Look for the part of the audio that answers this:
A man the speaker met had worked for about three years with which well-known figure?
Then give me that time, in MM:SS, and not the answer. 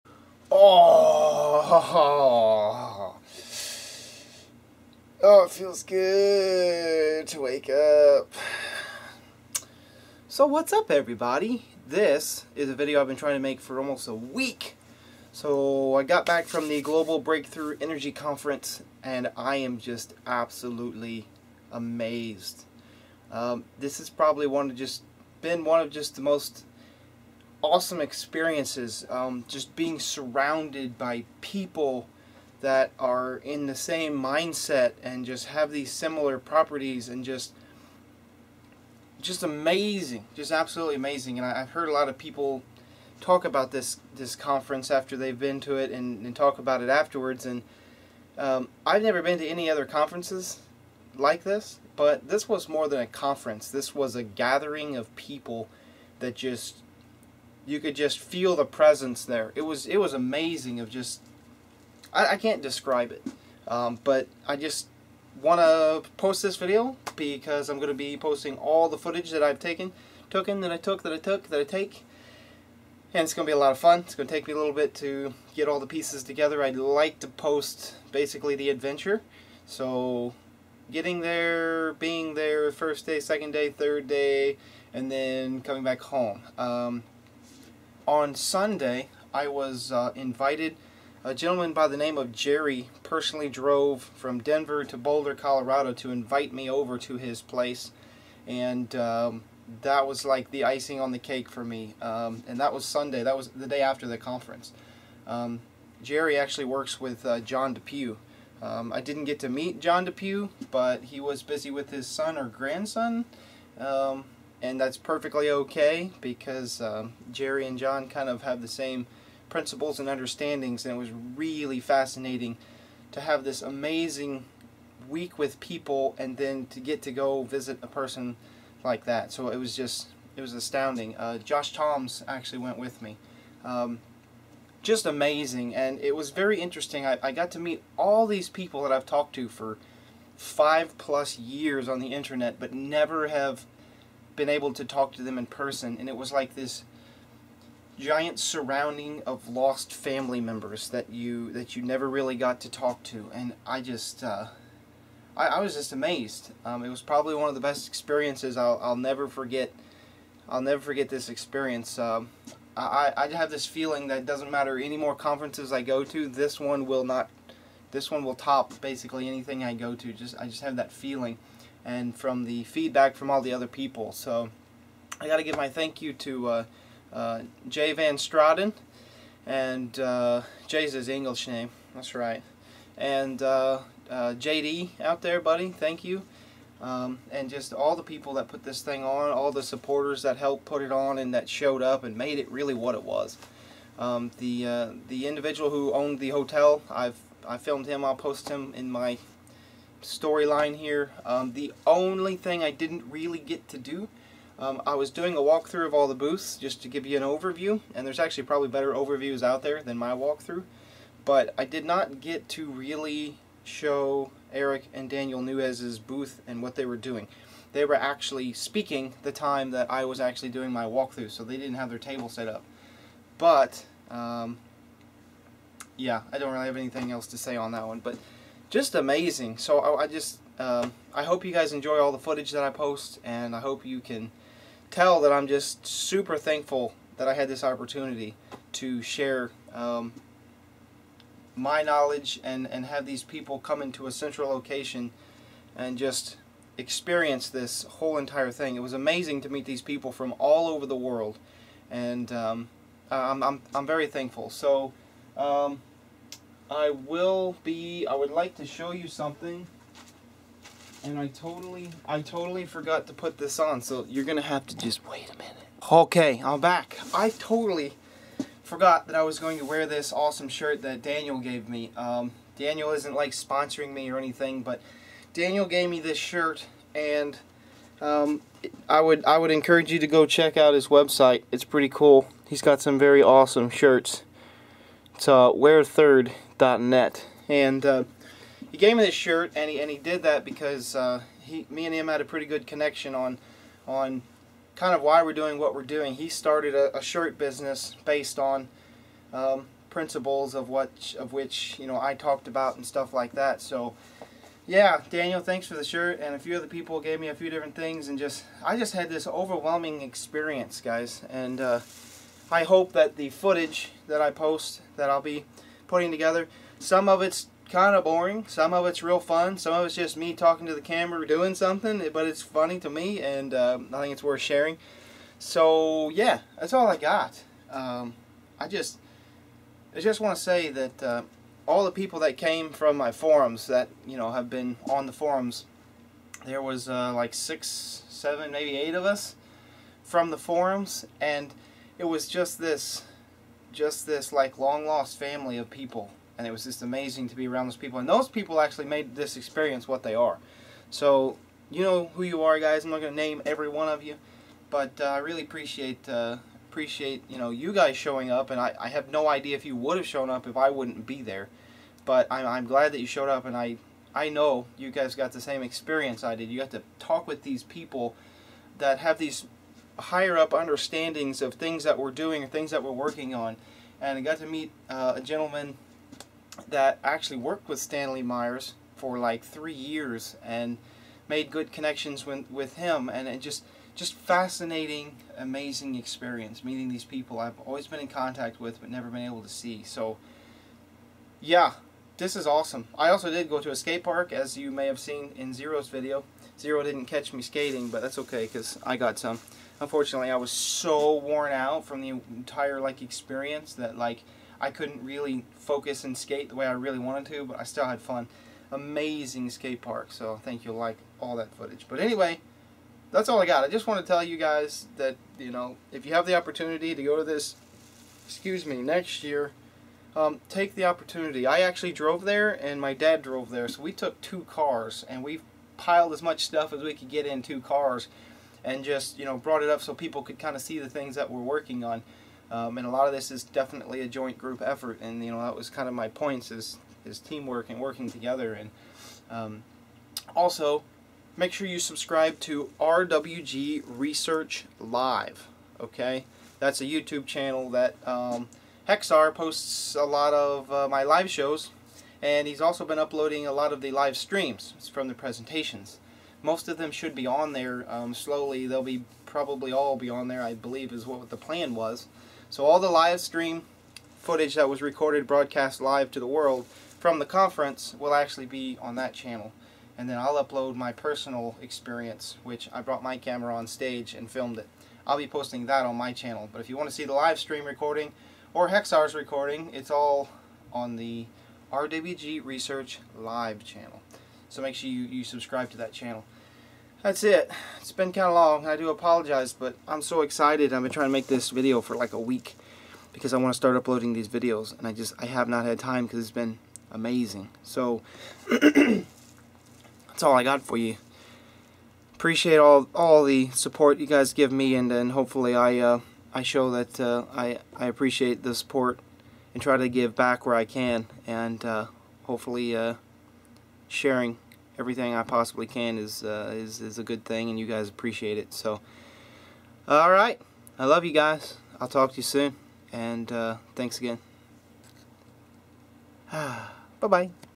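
06:17.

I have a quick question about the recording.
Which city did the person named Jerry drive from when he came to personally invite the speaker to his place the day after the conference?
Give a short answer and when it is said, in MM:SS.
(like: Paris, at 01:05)
Denver, at 01:34.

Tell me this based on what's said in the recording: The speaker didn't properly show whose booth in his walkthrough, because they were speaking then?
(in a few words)
Eric and Daniel Nuez.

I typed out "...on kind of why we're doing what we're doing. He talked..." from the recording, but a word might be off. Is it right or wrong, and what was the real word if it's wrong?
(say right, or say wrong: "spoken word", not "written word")
wrong: "started", not "talked".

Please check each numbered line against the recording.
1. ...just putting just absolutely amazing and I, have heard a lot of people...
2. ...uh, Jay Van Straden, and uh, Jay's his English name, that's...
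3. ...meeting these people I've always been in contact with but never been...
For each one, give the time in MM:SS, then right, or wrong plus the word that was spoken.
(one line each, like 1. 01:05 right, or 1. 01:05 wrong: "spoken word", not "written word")
1. 00:39 wrong: "amazing", not "putting"
2. 02:57 right
3. 06:26 right.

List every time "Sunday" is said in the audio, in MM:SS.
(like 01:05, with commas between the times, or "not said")
01:28, 01:42.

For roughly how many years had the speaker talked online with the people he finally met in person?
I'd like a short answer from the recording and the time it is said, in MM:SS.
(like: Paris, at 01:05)
5, at 02:20.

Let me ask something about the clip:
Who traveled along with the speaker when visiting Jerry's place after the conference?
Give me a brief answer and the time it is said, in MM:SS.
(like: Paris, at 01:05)
Josh Toms, at 02:11.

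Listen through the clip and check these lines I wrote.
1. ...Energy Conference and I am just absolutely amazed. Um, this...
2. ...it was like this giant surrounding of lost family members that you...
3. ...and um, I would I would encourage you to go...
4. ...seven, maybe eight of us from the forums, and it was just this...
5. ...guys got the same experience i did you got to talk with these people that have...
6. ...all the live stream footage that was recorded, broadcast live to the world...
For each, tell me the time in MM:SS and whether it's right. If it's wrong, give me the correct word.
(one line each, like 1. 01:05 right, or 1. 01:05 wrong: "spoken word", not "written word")
1. 00:17 right
2. 02:26 right
3. 04:36 right
4. 05:38 right
5. 06:04 right
6. 07:42 right.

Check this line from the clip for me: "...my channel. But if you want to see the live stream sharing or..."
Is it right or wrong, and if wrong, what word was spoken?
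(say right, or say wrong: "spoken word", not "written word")
wrong: "recording", not "sharing".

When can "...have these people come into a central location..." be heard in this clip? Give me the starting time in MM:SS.
04:02.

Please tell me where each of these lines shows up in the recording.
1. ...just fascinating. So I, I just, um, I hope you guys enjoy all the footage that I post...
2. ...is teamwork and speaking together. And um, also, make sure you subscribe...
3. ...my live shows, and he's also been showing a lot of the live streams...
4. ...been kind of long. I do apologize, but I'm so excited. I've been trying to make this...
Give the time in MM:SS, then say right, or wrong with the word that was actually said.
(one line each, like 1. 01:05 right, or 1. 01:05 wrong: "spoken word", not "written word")
1. 03:48 wrong: "amazing", not "fascinating"
2. 07:17 wrong: "working", not "speaking"
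3. 07:30 wrong: "uploading", not "showing"
4. 08:07 right.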